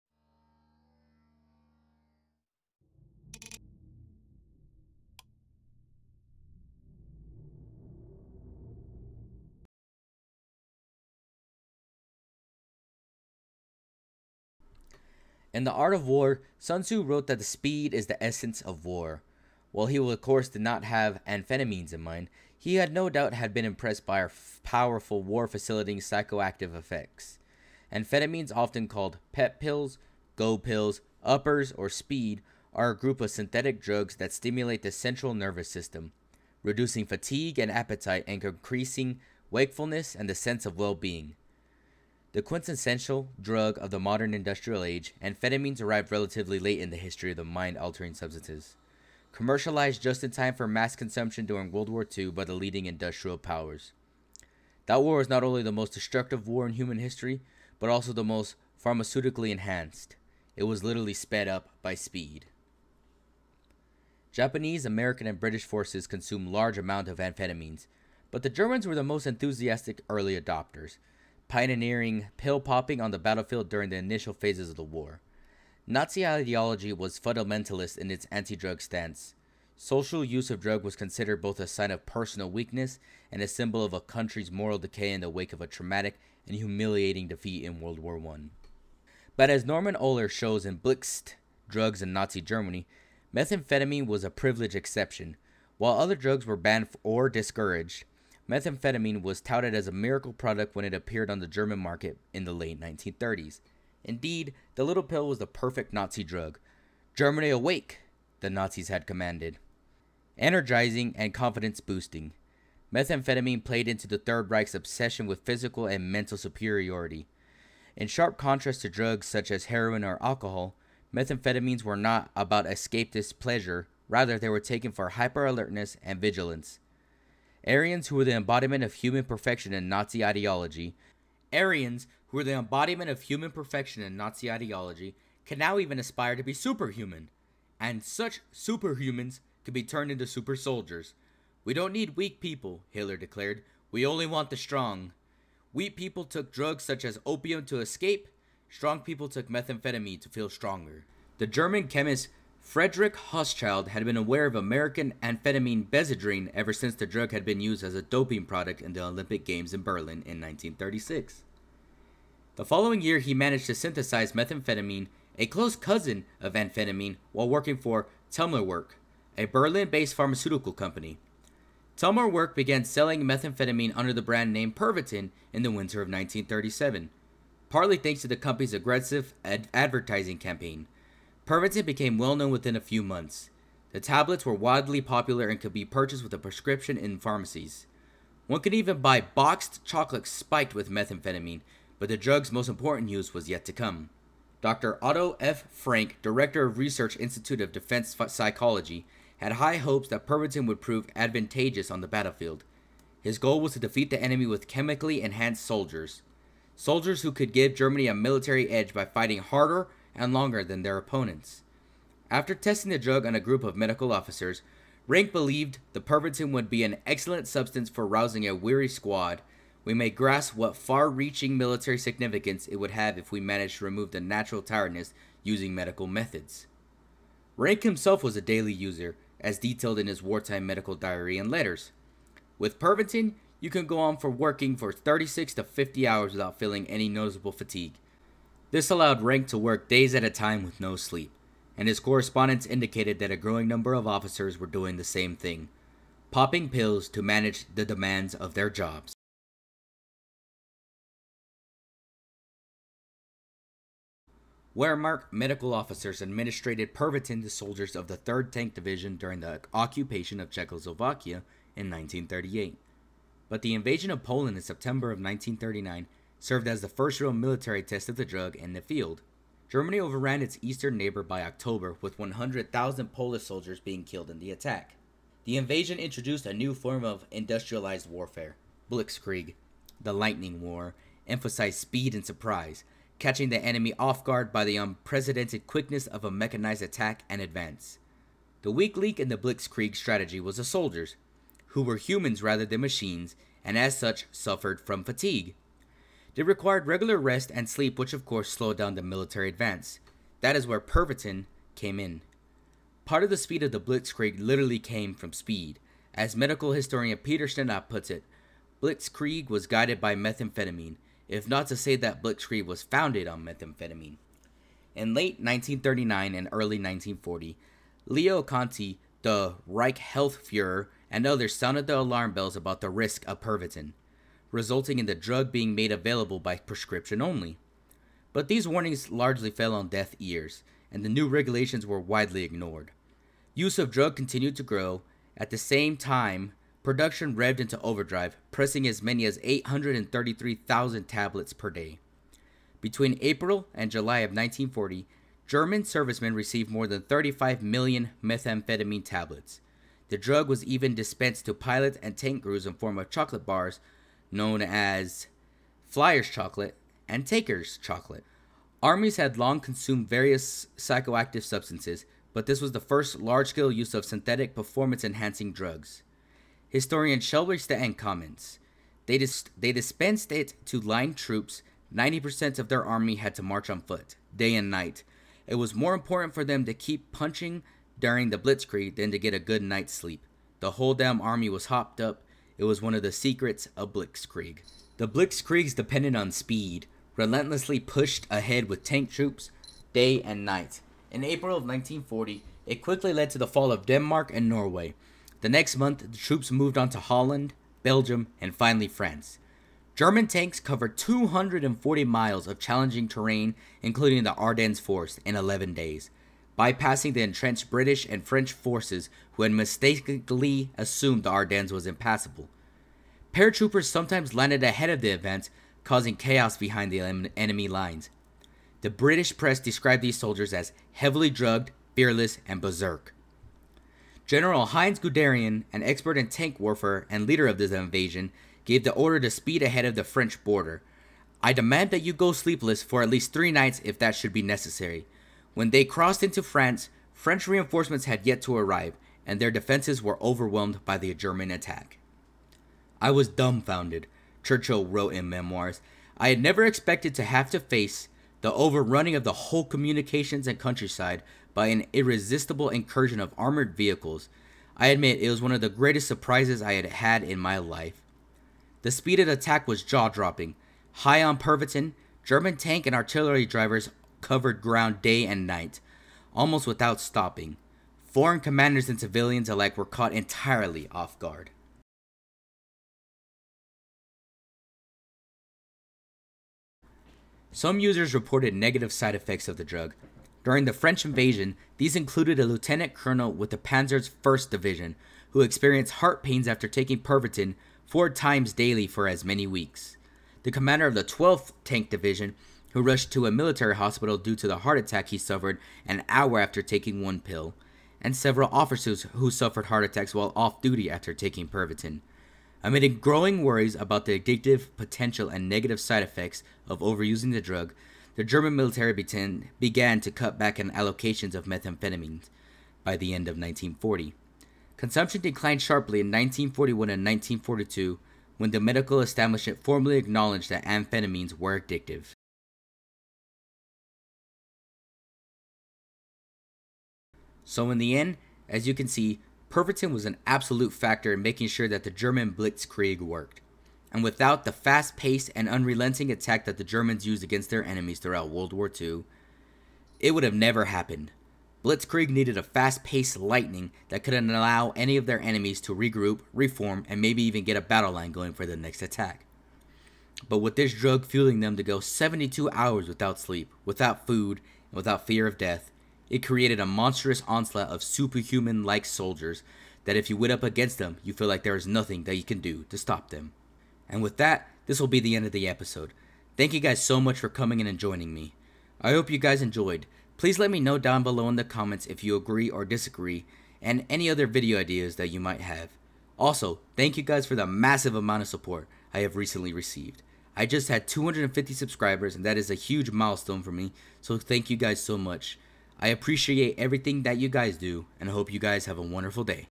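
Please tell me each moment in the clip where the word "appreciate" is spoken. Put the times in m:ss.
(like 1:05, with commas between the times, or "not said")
9:45.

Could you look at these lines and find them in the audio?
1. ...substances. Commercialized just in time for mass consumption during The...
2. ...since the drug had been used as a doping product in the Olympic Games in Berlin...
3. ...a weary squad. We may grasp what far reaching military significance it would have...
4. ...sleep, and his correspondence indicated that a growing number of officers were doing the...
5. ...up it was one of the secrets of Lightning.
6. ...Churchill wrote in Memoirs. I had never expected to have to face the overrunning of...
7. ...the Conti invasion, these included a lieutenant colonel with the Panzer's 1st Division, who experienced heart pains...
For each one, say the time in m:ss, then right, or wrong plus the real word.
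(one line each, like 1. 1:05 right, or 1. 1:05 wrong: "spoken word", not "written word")
1. 0:48 wrong: "World", not "The"
2. 2:36 right
3. 3:38 right
4. 4:00 right
5. 6:21 wrong: "Blitzkrieg", not "Lightning"
6. 7:24 right
7. 8:00 wrong: "French", not "Conti".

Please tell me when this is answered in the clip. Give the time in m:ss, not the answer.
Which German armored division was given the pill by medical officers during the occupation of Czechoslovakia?
4:18.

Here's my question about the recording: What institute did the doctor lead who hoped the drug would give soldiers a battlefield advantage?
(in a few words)
Research Institute of Defense Psychology.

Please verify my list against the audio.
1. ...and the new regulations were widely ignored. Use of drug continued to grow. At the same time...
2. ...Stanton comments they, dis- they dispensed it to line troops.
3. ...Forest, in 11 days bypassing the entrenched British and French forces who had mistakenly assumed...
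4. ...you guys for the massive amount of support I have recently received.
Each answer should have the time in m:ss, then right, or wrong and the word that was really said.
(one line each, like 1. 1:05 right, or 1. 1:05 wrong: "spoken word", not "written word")
1. 5:30 right
2. 6:07 right
3. 6:44 right
4. 9:36 right.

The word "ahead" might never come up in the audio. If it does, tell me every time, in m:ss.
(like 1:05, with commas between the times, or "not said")
6:28, 6:54, 7:09.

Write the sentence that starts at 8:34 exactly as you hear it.
Consumption declined sharply in 1941 and 1942 when the medical establishment formally acknowledged that amphetamines were addictive.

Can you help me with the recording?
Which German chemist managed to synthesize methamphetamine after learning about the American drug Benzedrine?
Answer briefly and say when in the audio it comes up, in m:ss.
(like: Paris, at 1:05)
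Frederick Hauschild, at 2:32.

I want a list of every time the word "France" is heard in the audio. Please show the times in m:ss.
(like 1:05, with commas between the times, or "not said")
6:38, 7:16.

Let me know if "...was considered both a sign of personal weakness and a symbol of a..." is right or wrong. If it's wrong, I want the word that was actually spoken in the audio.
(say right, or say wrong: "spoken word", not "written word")
right.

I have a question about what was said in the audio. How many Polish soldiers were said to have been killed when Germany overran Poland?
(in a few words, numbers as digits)
100,000.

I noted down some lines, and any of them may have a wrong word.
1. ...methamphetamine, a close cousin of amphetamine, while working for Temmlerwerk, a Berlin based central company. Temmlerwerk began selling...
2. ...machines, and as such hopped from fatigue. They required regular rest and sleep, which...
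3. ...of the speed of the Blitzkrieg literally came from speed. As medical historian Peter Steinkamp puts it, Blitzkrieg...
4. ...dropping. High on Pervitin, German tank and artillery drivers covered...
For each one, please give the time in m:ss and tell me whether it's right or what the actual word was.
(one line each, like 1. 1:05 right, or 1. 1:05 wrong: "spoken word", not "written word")
1. 2:44 wrong: "pharmaceutical", not "central"
2. 4:52 wrong: "suffered", not "hopped"
3. 5:03 right
4. 7:40 right.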